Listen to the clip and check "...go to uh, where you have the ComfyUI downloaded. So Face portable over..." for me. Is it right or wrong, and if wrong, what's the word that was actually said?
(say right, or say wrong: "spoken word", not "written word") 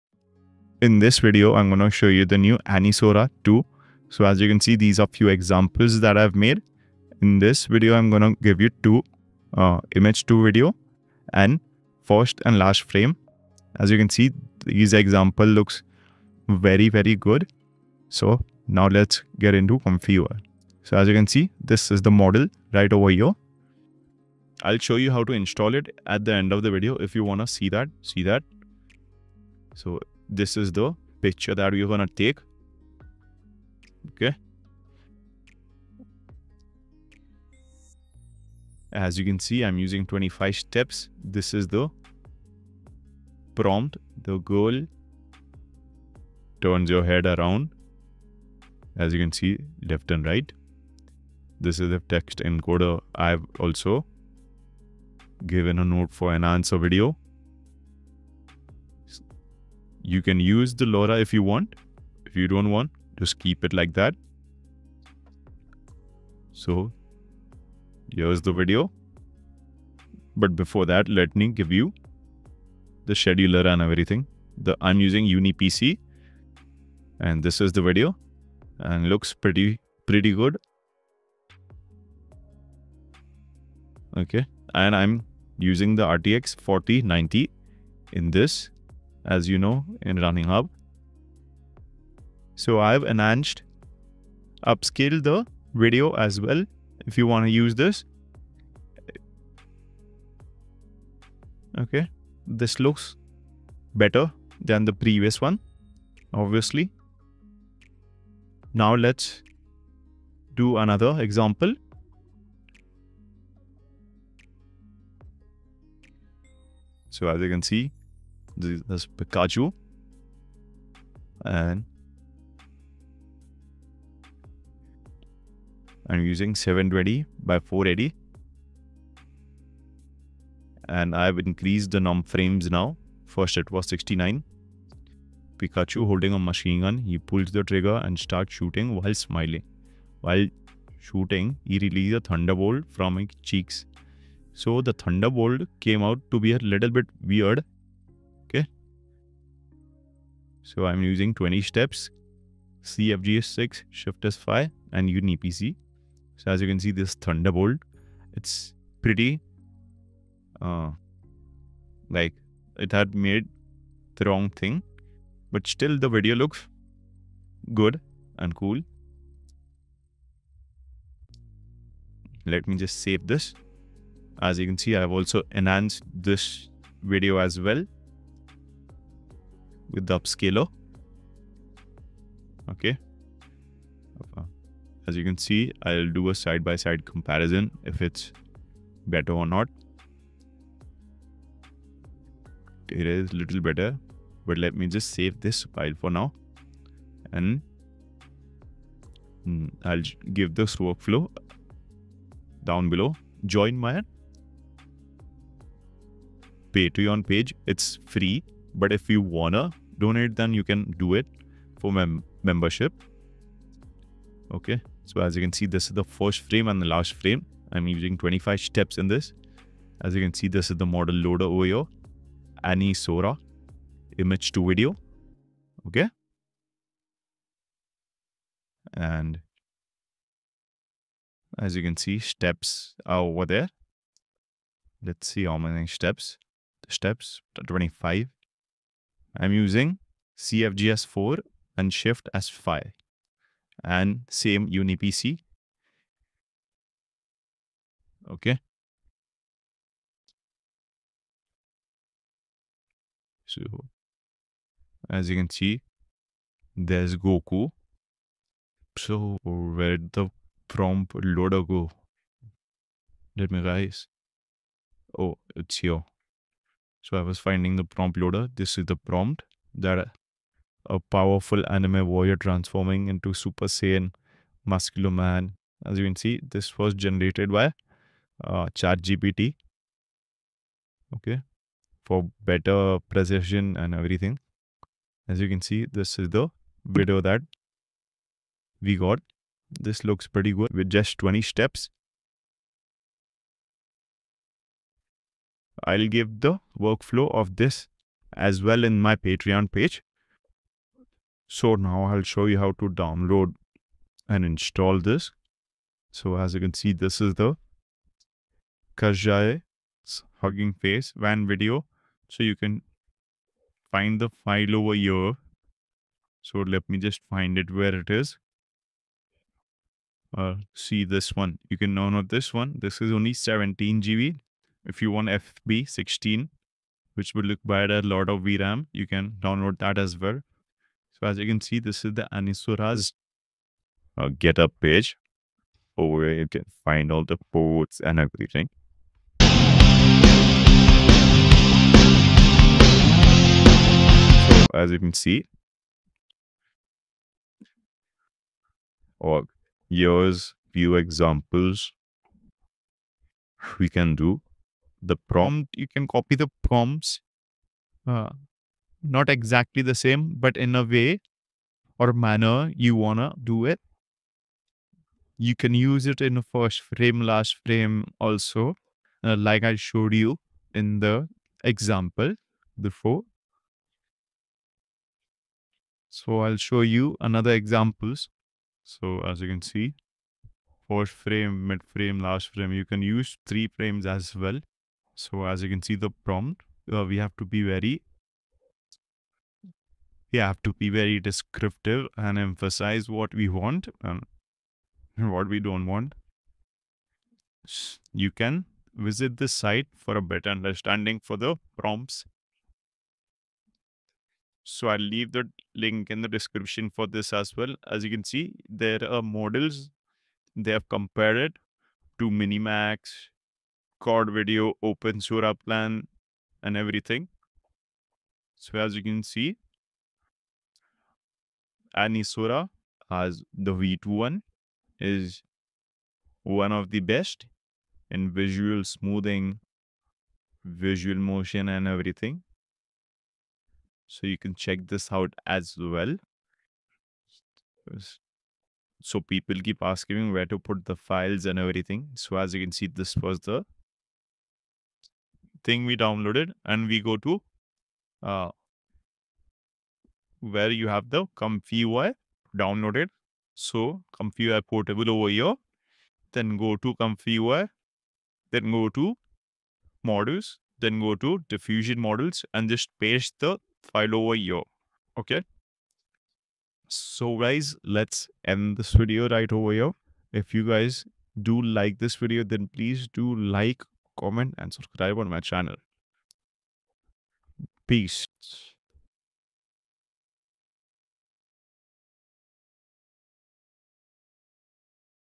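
wrong: "ComfyUI", not "Face".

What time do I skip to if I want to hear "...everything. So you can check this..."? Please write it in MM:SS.
07:11.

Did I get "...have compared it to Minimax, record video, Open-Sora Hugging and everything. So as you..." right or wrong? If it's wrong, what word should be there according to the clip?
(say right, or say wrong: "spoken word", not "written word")
wrong: "Plan", not "Hugging".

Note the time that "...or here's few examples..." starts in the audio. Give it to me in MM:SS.
05:49.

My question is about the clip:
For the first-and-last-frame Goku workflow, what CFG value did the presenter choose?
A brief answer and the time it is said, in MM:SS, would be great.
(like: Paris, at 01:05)
4, at 04:00.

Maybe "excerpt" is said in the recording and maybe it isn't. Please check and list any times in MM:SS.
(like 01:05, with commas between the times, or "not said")
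not said.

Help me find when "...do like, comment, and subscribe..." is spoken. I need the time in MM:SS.
07:53.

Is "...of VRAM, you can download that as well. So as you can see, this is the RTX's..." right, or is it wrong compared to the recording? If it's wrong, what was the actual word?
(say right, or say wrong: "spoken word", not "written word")
wrong: "Anisora", not "RTX".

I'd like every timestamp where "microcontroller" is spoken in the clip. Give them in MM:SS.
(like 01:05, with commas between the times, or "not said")
not said.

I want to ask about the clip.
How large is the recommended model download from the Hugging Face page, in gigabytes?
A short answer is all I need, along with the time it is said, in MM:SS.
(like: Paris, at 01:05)
17 GB, at 05:23.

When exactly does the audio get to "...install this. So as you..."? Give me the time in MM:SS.
05:04.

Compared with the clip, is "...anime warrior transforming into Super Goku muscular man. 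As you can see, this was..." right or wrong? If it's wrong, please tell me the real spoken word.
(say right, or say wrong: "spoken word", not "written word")
wrong: "Saiyan", not "Goku".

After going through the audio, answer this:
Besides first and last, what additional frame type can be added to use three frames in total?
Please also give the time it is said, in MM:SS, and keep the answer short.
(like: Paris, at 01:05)
mid frame, at 06:21.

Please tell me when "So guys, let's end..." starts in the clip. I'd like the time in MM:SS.
07:46.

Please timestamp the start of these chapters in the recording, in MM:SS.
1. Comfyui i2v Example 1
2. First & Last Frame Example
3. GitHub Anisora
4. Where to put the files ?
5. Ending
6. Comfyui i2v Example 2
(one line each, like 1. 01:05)
1. 00:20
2. 03:25
3. 05:07
4. 07:20
5. 08:00
6. 02:15.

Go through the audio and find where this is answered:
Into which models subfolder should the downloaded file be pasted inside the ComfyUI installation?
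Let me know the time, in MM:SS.
07:41.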